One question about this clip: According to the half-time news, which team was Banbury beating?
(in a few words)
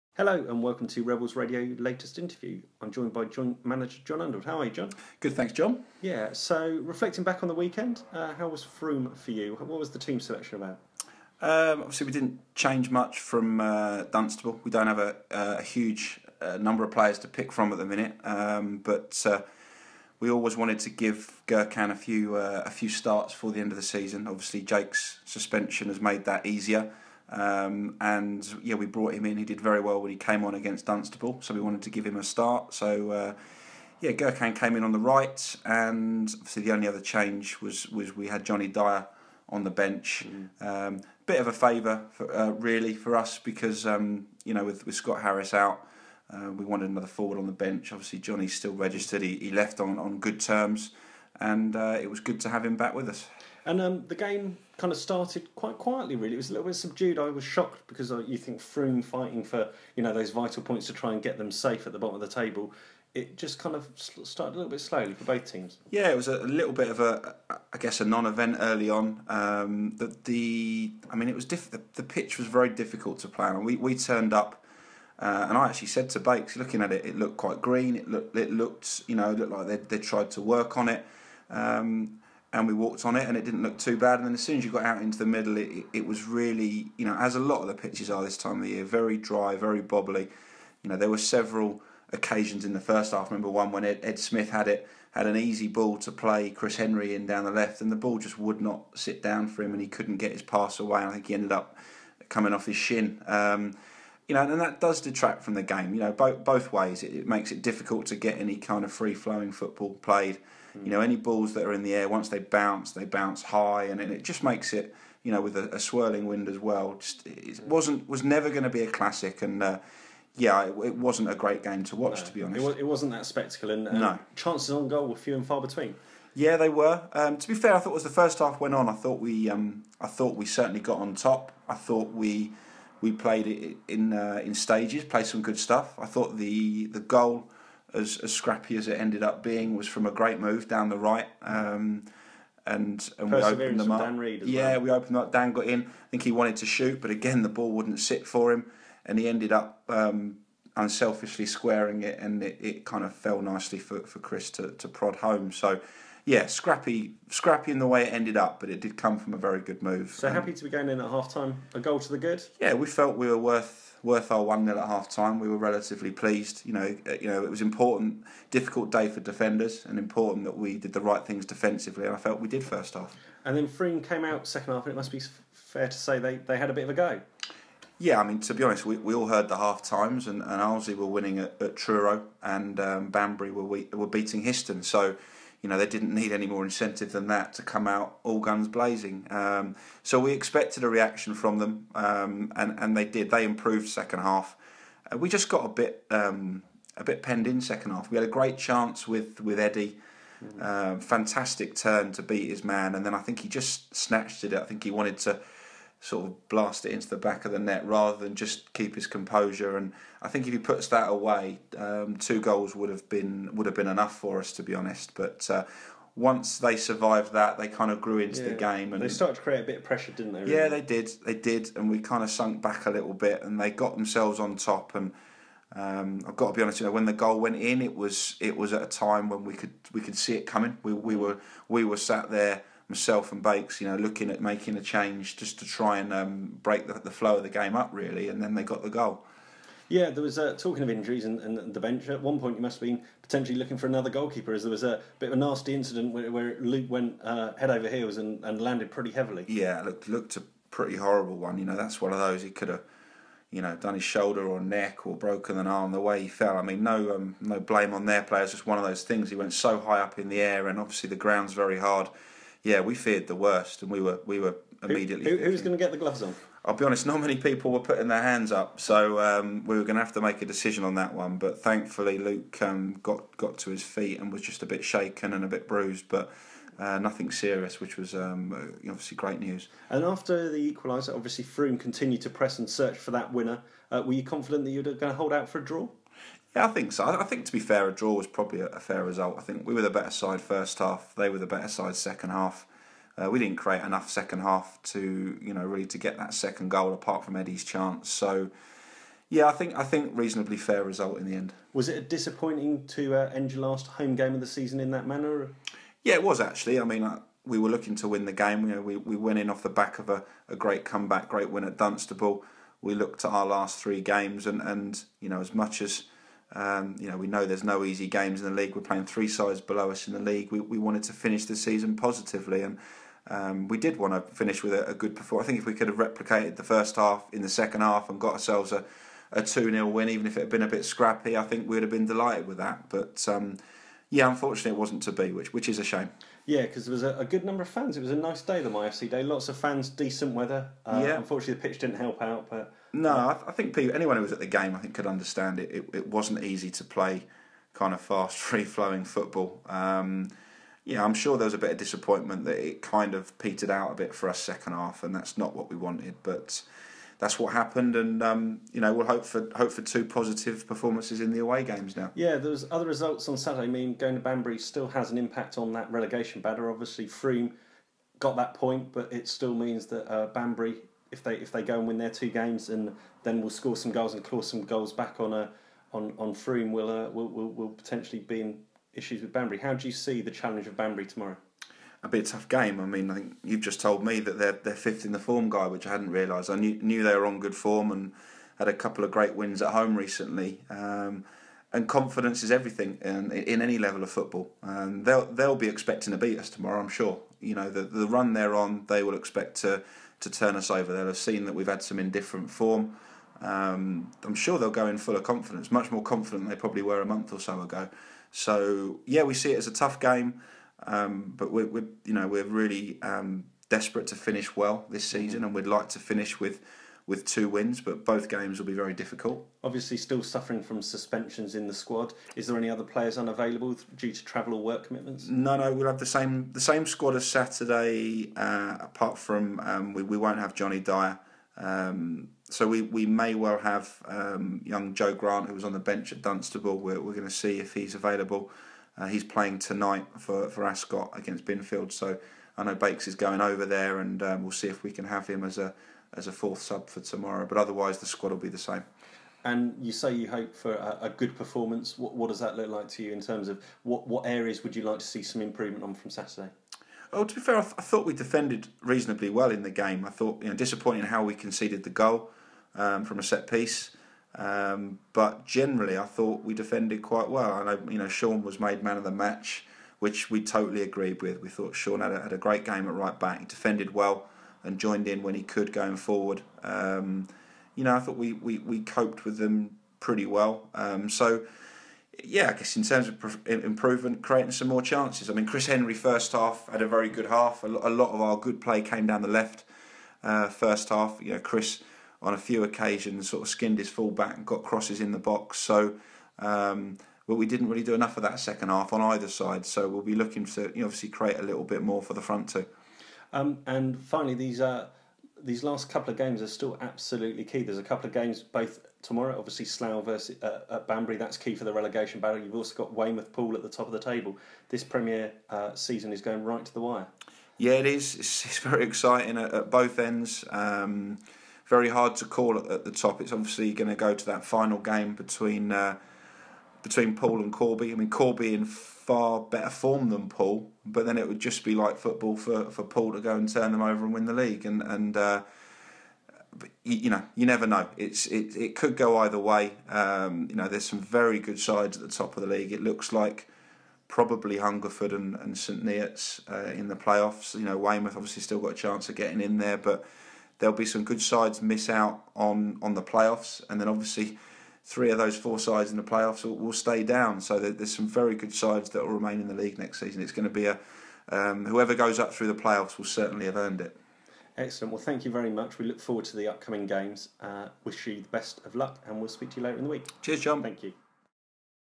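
Histon.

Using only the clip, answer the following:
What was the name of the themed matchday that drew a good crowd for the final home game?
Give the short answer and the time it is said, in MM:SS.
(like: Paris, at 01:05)
MyFC day, at 05:38.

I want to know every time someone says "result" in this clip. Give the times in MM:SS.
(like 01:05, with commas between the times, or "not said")
04:49, 05:00, 06:02.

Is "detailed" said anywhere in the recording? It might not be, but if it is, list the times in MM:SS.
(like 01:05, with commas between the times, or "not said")
not said.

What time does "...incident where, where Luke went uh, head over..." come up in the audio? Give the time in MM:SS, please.
04:05.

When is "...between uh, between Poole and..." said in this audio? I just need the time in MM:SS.
08:45.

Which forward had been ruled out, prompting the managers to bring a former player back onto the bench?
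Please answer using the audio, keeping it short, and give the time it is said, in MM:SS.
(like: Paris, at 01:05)
Scott Harris, at 00:44.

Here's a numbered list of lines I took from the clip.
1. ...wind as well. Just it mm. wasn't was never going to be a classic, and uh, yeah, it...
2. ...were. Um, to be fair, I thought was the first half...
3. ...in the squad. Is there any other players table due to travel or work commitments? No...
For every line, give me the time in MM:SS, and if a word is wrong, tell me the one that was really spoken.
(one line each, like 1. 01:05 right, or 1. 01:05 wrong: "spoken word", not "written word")
1. 01:56 right
2. 02:06 right
3. 07:01 wrong: "unavailable", not "table".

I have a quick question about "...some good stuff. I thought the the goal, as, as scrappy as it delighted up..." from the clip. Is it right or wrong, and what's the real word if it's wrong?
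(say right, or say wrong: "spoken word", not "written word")
wrong: "ended", not "delighted".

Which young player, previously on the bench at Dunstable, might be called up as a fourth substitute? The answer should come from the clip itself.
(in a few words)
Joe Grant.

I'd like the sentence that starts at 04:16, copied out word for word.
I mean, no um, no blame on their players.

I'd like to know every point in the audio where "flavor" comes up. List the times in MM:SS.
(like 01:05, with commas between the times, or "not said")
not said.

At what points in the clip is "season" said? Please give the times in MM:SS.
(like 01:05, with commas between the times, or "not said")
00:23, 05:04, 05:21, 06:55, 08:35, 09:20.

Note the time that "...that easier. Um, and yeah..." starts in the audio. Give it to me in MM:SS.
00:26.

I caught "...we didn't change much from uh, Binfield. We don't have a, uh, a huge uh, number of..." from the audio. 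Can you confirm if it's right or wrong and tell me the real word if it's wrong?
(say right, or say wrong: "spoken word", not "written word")
wrong: "Dunstable", not "Binfield".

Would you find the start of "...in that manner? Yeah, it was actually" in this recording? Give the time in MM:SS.
05:04.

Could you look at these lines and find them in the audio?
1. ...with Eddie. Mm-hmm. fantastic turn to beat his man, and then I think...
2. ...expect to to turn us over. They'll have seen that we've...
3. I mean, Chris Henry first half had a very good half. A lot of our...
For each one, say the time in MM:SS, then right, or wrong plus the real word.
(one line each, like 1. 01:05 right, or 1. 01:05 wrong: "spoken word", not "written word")
1. 03:19 right
2. 06:39 right
3. 08:05 right.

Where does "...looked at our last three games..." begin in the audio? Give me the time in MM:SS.
05:12.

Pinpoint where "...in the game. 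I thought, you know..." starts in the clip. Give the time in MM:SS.
07:39.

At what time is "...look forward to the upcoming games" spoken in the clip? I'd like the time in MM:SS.
09:25.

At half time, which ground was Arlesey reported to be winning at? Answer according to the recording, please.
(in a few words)
Truro.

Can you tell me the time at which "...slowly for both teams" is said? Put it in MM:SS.
01:04.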